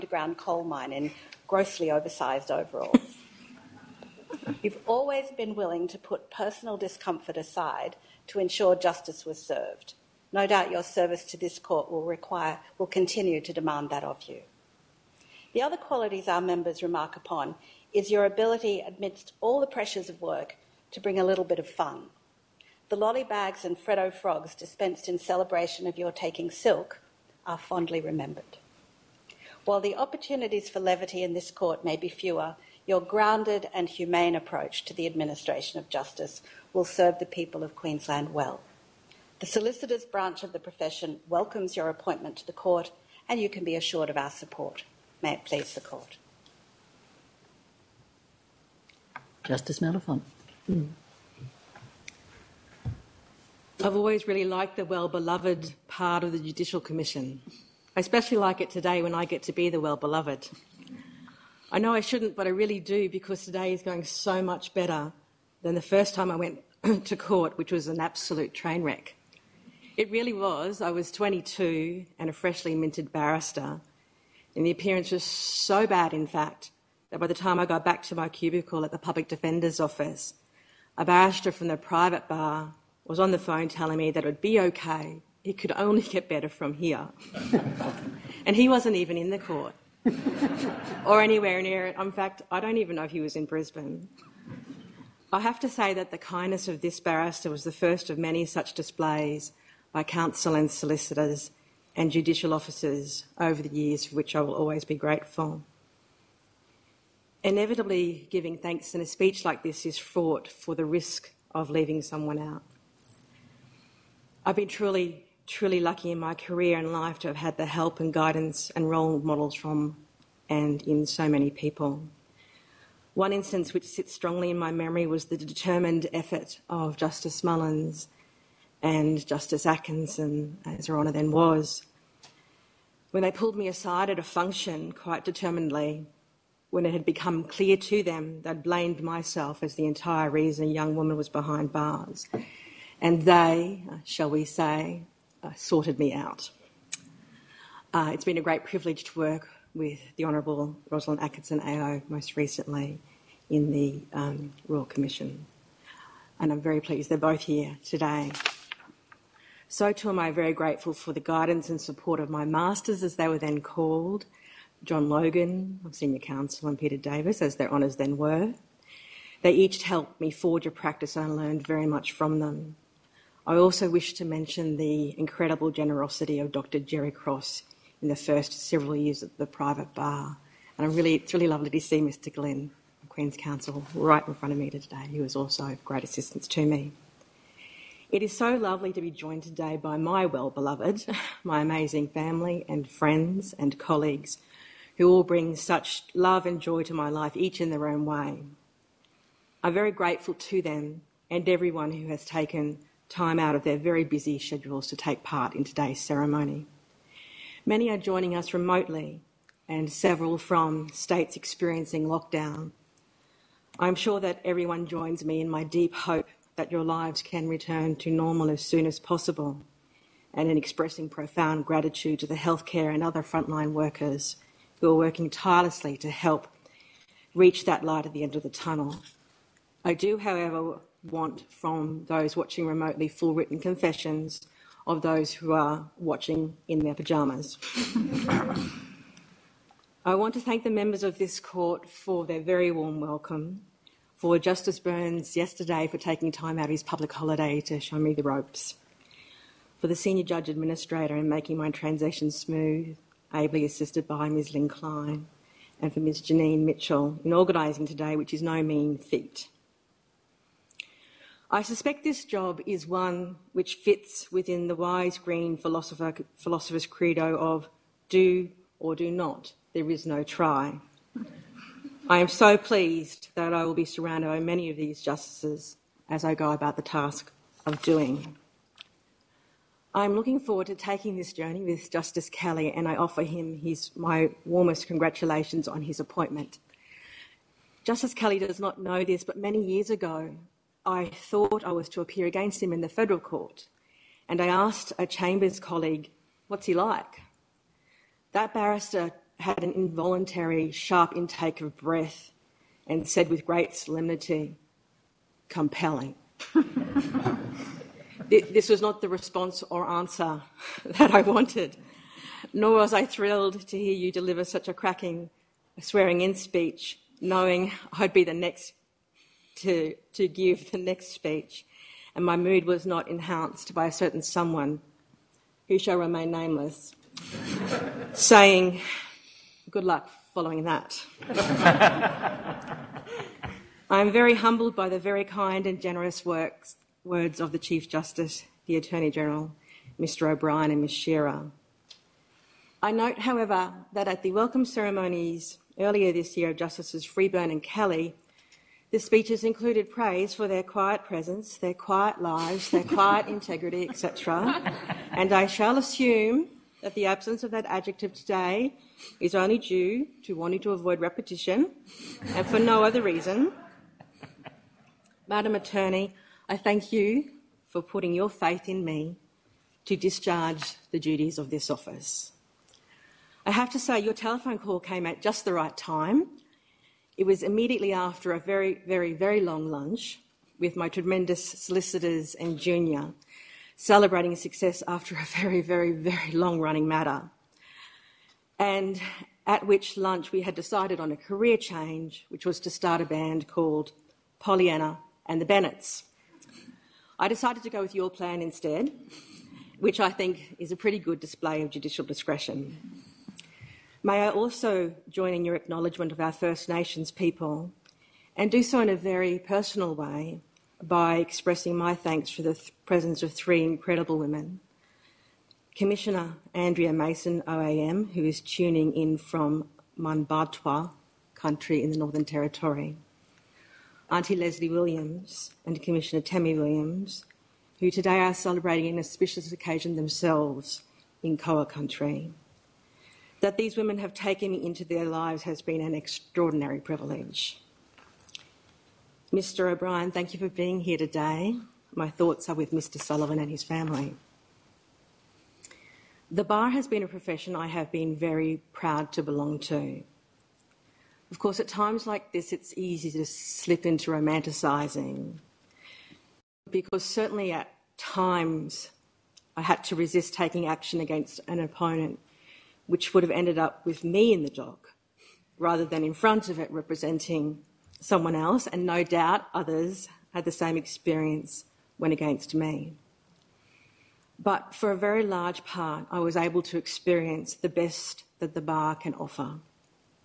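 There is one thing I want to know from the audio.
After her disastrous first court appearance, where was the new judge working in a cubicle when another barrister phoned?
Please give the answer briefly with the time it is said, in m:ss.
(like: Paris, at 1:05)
public defender's office, at 1:18.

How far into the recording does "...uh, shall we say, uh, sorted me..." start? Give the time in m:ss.
2:23.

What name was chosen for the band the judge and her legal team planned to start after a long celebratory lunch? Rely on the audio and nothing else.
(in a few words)
Pollyanna and the Bennets.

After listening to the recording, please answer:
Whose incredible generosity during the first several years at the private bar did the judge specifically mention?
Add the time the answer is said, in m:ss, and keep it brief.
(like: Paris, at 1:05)
Dr. Jerry Cross, at 2:56.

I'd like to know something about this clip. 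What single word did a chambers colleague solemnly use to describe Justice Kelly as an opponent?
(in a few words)
Compelling.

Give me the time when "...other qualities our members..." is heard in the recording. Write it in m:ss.
0:15.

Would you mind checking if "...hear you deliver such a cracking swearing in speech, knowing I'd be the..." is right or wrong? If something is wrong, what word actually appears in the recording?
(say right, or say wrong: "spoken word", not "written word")
right.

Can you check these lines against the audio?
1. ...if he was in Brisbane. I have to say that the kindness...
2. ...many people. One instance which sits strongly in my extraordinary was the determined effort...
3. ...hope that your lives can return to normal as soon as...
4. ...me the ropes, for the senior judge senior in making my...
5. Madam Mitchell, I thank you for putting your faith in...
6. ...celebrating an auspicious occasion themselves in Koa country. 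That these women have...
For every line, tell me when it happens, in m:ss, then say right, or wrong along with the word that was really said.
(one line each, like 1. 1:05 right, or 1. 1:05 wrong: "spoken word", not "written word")
1. 1:33 right
2. 2:01 wrong: "memory", not "extraordinary"
3. 3:35 right
4. 4:07 wrong: "administrator", not "senior"
5. 6:05 wrong: "Attorney", not "Mitchell"
6. 7:08 right.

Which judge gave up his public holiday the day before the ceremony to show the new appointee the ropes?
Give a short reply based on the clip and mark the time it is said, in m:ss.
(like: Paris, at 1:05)
Justice Burns, at 4:04.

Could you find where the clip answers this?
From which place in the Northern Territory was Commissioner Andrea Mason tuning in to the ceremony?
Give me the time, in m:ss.
6:59.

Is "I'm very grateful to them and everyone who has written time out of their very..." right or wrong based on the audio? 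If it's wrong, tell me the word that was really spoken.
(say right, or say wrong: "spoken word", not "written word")
wrong: "taken", not "written".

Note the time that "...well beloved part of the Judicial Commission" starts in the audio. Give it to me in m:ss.
0:54.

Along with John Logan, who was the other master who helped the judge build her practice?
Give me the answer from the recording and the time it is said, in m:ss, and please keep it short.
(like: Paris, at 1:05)
Peter Davis, at 2:46.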